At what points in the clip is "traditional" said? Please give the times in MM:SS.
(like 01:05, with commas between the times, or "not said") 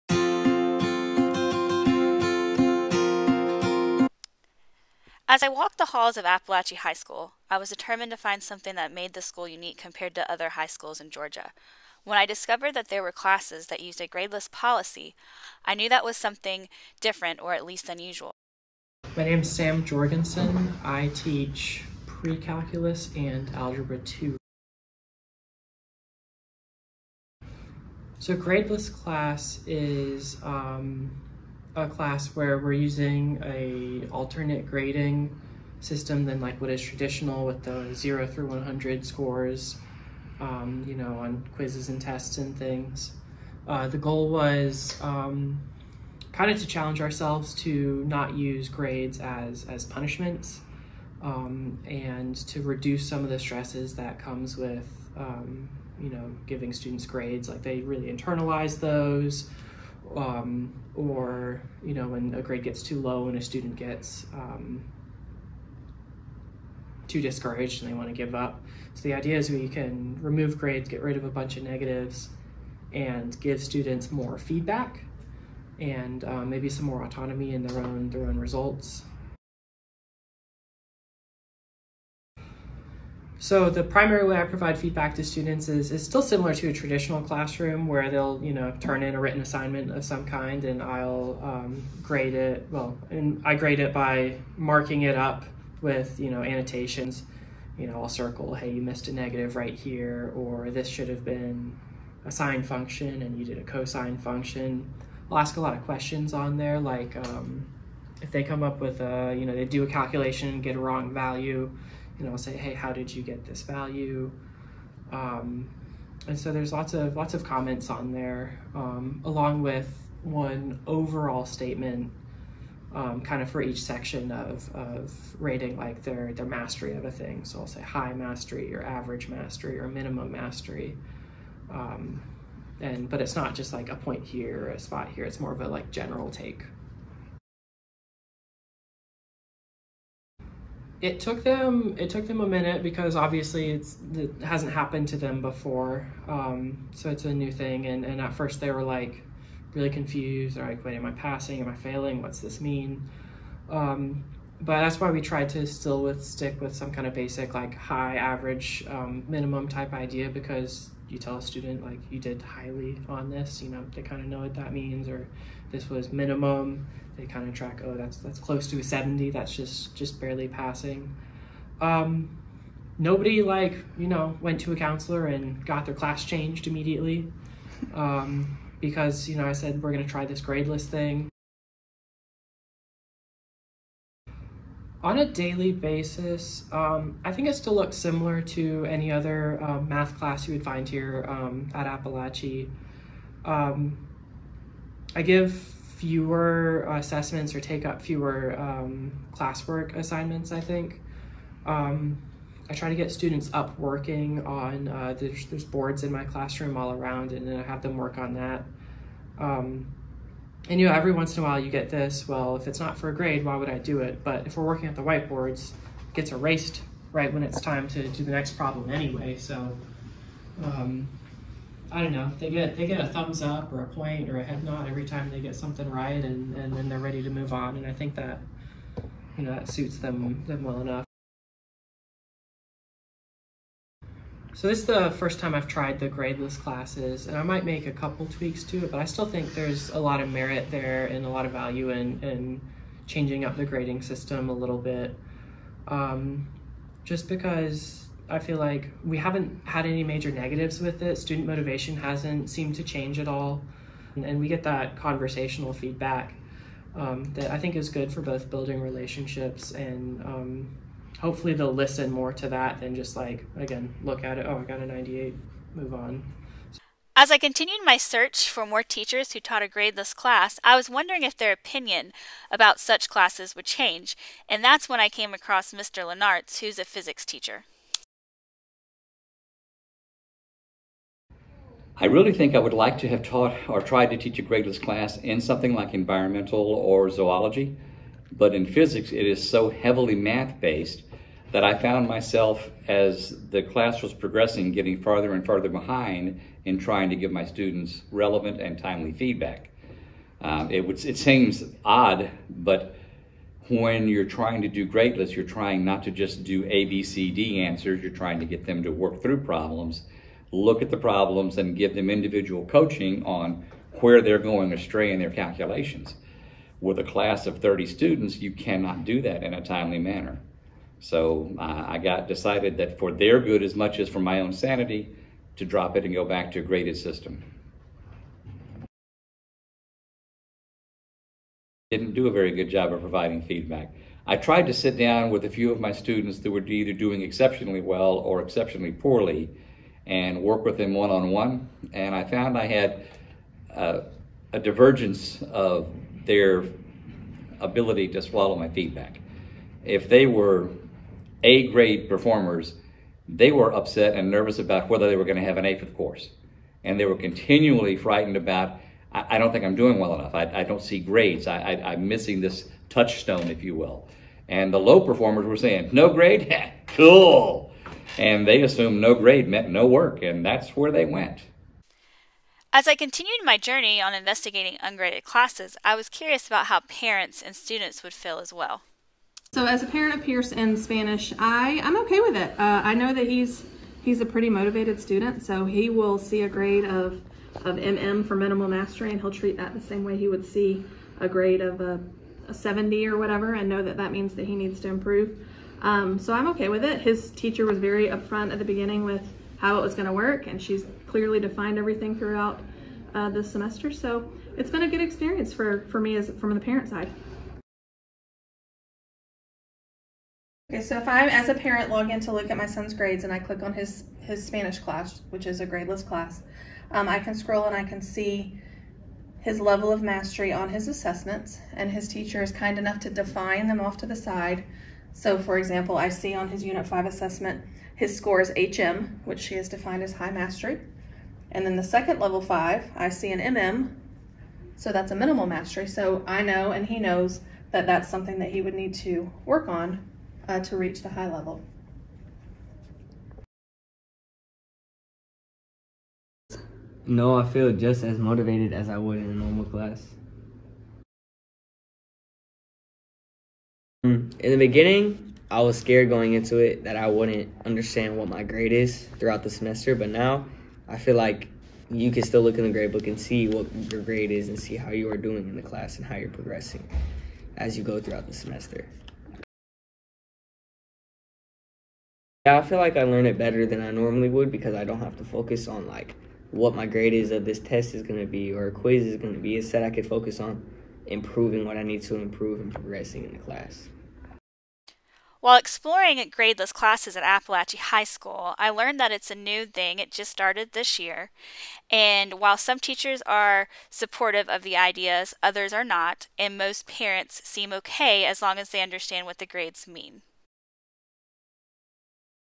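00:36, 01:26.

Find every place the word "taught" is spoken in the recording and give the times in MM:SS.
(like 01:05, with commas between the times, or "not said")
04:29, 04:43.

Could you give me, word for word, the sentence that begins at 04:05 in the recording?
Um, just because I feel like we haven't had any major negatives with it.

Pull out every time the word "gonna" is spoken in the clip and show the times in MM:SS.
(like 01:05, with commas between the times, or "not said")
02:59, 06:39.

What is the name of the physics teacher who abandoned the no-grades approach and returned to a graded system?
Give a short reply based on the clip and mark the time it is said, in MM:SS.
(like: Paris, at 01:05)
Mr. Lenartz, at 04:35.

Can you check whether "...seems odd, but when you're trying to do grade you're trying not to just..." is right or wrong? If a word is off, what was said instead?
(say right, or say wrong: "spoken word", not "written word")
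right.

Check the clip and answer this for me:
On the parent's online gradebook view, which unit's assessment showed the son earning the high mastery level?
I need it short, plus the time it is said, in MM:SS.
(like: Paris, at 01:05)
Unit 5, at 07:06.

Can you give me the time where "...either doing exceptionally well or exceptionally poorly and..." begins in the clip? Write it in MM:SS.
05:36.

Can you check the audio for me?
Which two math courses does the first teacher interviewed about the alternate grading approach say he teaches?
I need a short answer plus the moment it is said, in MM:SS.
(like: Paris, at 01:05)
Pre calculus and algebra 2, at 00:22.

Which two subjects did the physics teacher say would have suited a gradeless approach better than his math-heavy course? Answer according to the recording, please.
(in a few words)
Environmental or zoology.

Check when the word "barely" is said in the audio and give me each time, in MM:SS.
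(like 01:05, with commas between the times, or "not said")
02:50.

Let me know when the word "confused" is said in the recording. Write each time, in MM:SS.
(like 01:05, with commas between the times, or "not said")
02:29.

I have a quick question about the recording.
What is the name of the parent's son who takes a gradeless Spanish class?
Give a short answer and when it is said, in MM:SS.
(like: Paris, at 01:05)
Pierce, at 06:20.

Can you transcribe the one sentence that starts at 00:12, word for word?
When I discovered that there were classes that used a gradeless policy, I knew that was something different or at least unusual.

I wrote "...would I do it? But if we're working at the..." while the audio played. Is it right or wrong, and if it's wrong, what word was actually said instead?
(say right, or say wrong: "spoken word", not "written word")
right.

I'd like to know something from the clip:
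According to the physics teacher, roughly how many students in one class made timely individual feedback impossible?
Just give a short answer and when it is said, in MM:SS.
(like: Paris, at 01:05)
30, at 05:17.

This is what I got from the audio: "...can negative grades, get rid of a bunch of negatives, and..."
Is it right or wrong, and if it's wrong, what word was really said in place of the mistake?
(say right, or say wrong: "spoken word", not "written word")
wrong: "remove", not "negative".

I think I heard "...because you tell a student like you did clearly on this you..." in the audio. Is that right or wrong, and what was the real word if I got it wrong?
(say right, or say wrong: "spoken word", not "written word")
wrong: "highly", not "clearly".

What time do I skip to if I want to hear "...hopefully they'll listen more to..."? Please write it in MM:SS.
04:21.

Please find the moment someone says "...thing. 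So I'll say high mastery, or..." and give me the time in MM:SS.
02:07.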